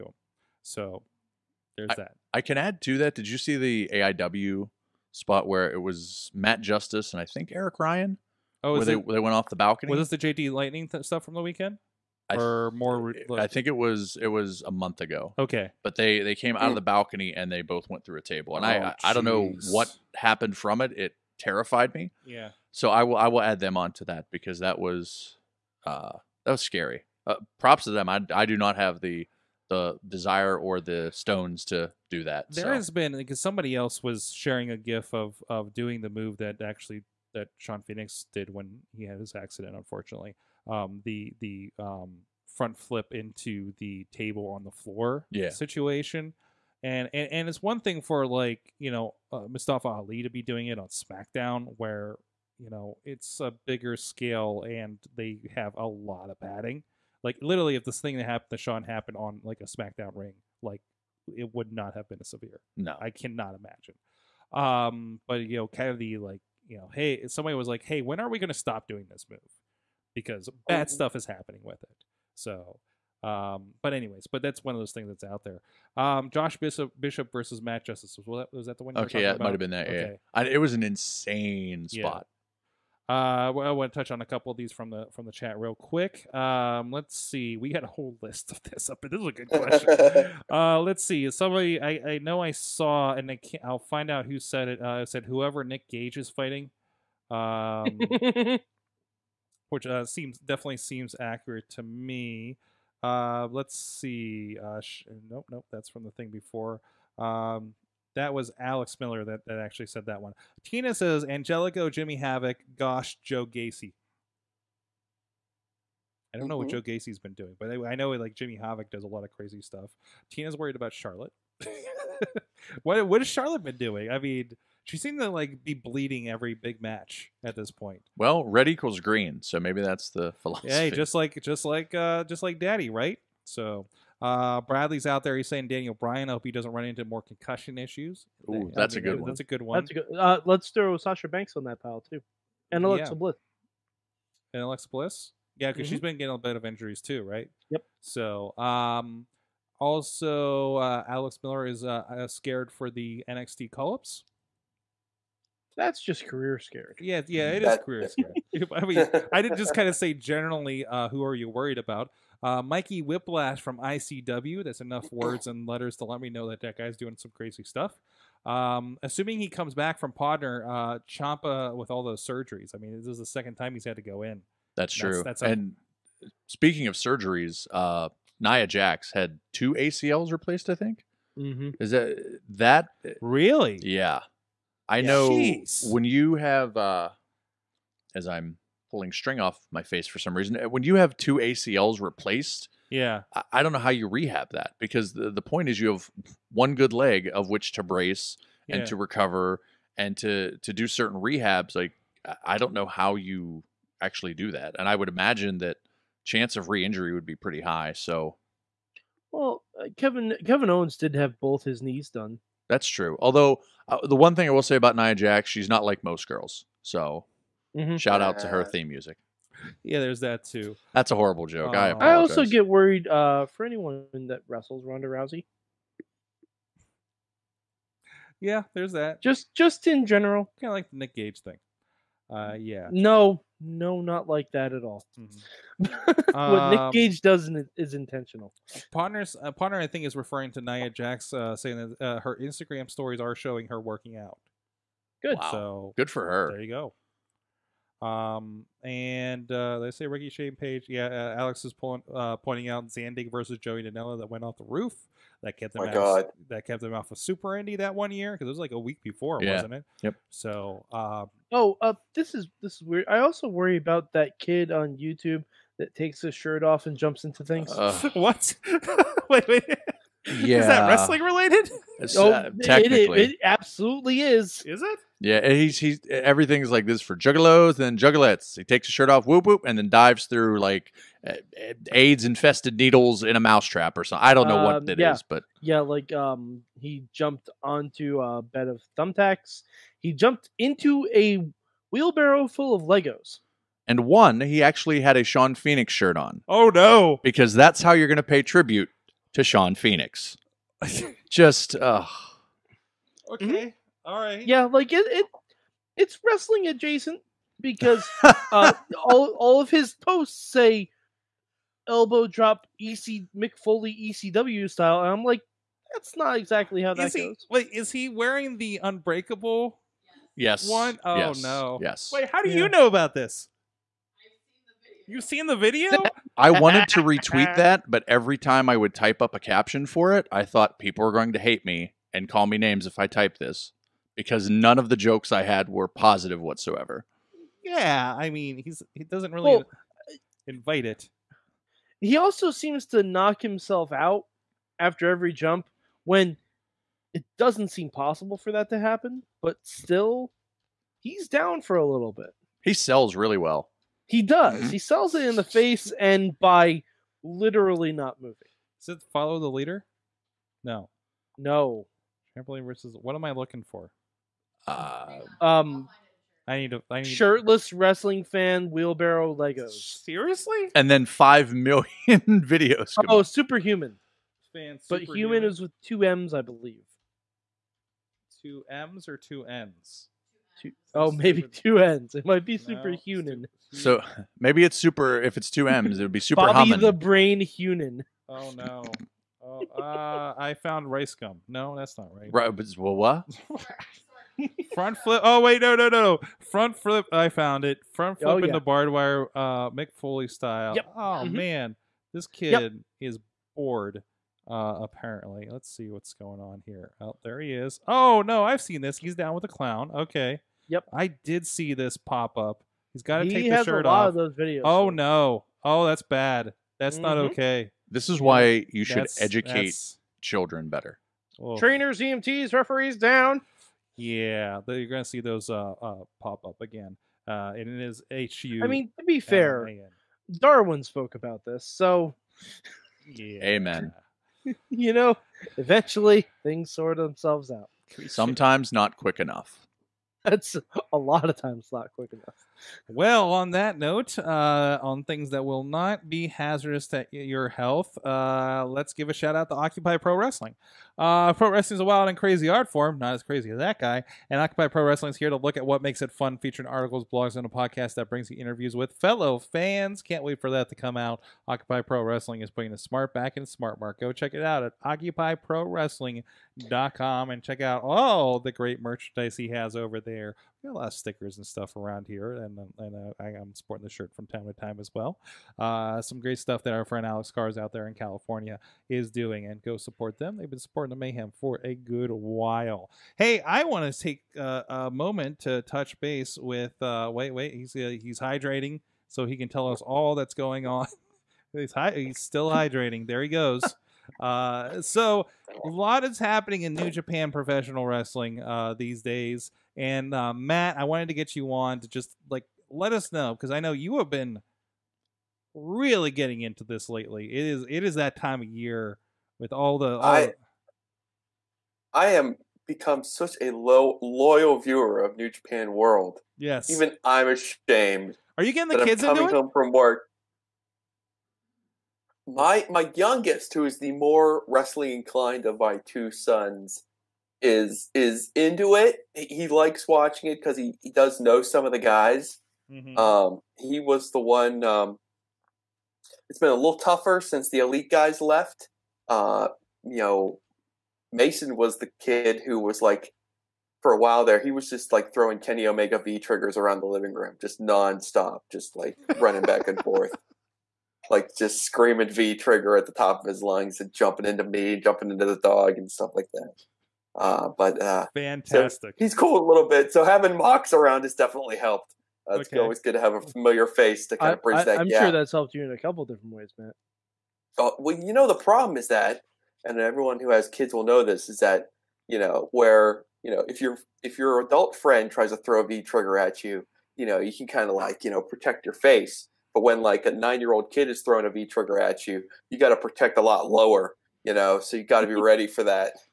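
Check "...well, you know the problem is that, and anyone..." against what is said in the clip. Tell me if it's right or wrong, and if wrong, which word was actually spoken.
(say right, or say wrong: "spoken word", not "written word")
wrong: "everyone", not "anyone".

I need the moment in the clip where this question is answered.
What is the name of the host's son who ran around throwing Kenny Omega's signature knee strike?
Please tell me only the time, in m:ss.
9:01.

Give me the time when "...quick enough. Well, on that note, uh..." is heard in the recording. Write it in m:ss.
7:21.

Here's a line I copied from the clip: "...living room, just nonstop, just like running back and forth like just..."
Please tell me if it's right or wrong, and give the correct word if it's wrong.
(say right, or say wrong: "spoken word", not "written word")
right.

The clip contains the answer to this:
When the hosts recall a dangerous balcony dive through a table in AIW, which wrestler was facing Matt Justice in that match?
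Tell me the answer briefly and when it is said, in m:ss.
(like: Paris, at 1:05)
Josh Bishop, at 1:16.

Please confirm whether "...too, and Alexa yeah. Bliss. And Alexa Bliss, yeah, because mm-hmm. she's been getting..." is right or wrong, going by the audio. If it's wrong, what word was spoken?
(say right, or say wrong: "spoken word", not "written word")
right.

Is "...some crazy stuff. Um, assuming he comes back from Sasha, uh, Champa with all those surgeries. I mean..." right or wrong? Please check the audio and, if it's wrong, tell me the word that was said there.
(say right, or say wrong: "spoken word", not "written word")
wrong: "Podner", not "Sasha".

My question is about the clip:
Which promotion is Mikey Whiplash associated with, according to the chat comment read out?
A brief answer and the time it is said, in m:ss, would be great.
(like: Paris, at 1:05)
ICW, at 2:43.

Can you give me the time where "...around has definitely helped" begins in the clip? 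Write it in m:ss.
9:20.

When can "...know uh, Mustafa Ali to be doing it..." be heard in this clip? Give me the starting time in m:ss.
0:48.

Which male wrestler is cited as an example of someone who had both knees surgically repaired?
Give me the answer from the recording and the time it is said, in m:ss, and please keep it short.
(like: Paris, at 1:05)
Kevin Owens, at 3:30.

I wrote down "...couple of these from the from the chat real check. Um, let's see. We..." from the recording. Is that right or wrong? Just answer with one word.
wrong.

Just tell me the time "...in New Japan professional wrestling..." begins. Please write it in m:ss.
8:16.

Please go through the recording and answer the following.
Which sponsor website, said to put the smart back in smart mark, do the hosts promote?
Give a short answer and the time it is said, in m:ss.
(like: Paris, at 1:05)
occupyprowrestling.com, at 7:44.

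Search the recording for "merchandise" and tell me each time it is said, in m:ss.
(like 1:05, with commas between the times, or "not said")
7:48.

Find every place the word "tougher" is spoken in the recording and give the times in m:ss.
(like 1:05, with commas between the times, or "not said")
8:56.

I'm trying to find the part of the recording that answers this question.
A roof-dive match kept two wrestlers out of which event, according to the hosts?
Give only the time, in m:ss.
4:17.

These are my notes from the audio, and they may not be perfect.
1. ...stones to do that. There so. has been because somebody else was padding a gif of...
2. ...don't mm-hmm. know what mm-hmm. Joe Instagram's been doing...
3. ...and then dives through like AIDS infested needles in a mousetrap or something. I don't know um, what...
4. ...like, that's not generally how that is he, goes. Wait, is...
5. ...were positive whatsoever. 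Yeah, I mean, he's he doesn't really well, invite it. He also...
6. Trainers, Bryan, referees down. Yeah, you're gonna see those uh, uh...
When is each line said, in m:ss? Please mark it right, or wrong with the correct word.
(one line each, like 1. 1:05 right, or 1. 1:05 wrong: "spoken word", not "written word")
1. 0:31 wrong: "sharing", not "padding"
2. 1:56 wrong: "Gacy", not "Instagram"
3. 4:39 right
4. 5:15 wrong: "exactly", not "generally"
5. 5:35 right
6. 7:01 wrong: "EMTs", not "Bryan".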